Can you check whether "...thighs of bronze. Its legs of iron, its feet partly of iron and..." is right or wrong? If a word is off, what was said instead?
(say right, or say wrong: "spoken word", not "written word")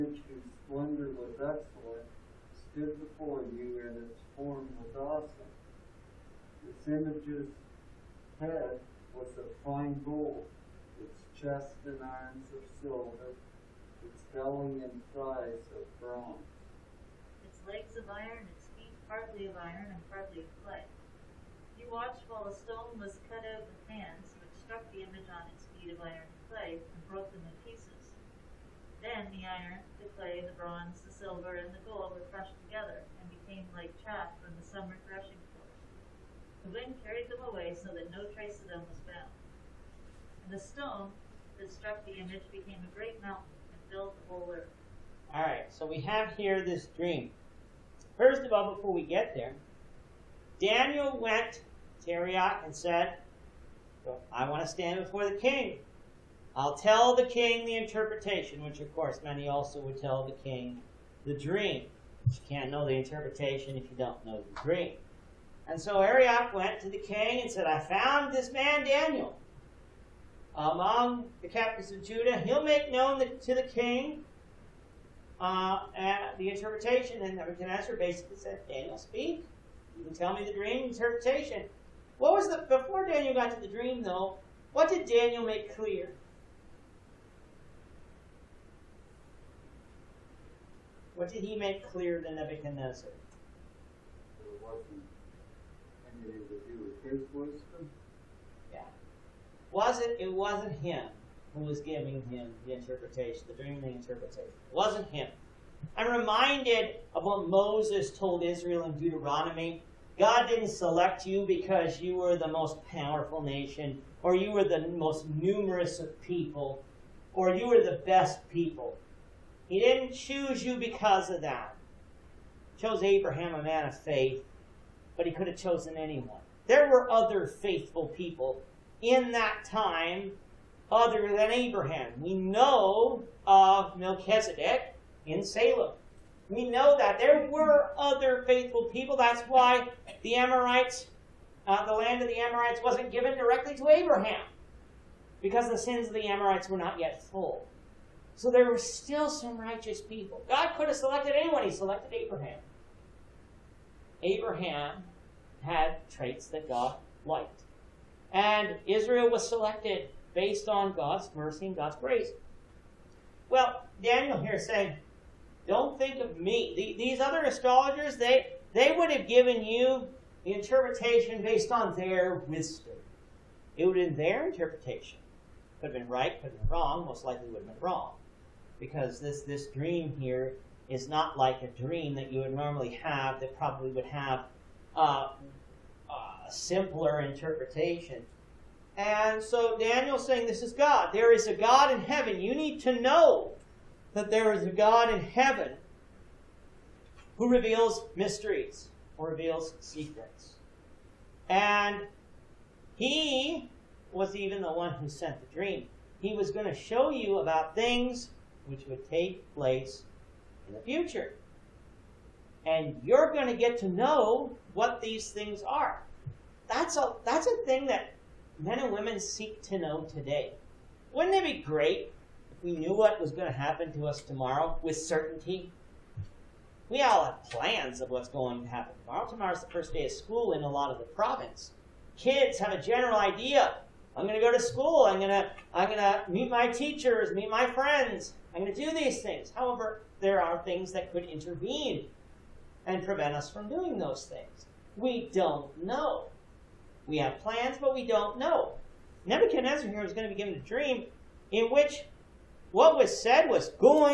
right.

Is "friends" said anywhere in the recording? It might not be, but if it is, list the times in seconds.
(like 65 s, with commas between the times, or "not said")
237 s.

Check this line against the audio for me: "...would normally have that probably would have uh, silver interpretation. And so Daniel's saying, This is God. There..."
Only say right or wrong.
wrong.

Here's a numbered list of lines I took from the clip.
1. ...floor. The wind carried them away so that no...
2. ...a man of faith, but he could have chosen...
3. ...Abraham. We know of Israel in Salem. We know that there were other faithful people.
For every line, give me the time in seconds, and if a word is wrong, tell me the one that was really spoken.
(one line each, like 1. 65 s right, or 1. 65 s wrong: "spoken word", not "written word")
1. 35 s right
2. 123 s right
3. 131 s wrong: "Melchizedek", not "Israel".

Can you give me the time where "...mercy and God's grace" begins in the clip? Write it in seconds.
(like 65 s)
161 s.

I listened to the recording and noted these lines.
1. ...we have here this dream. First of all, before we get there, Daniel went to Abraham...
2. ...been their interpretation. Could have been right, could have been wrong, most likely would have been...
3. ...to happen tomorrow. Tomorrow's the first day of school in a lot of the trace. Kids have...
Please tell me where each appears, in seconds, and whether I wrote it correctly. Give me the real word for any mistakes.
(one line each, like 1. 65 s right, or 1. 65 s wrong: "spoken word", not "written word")
1. 45 s wrong: "Arioch", not "Abraham"
2. 174 s right
3. 228 s wrong: "province", not "trace".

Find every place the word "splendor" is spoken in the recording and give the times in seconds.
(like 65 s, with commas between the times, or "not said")
0 s.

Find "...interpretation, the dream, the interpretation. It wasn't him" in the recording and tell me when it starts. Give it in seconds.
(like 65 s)
102 s.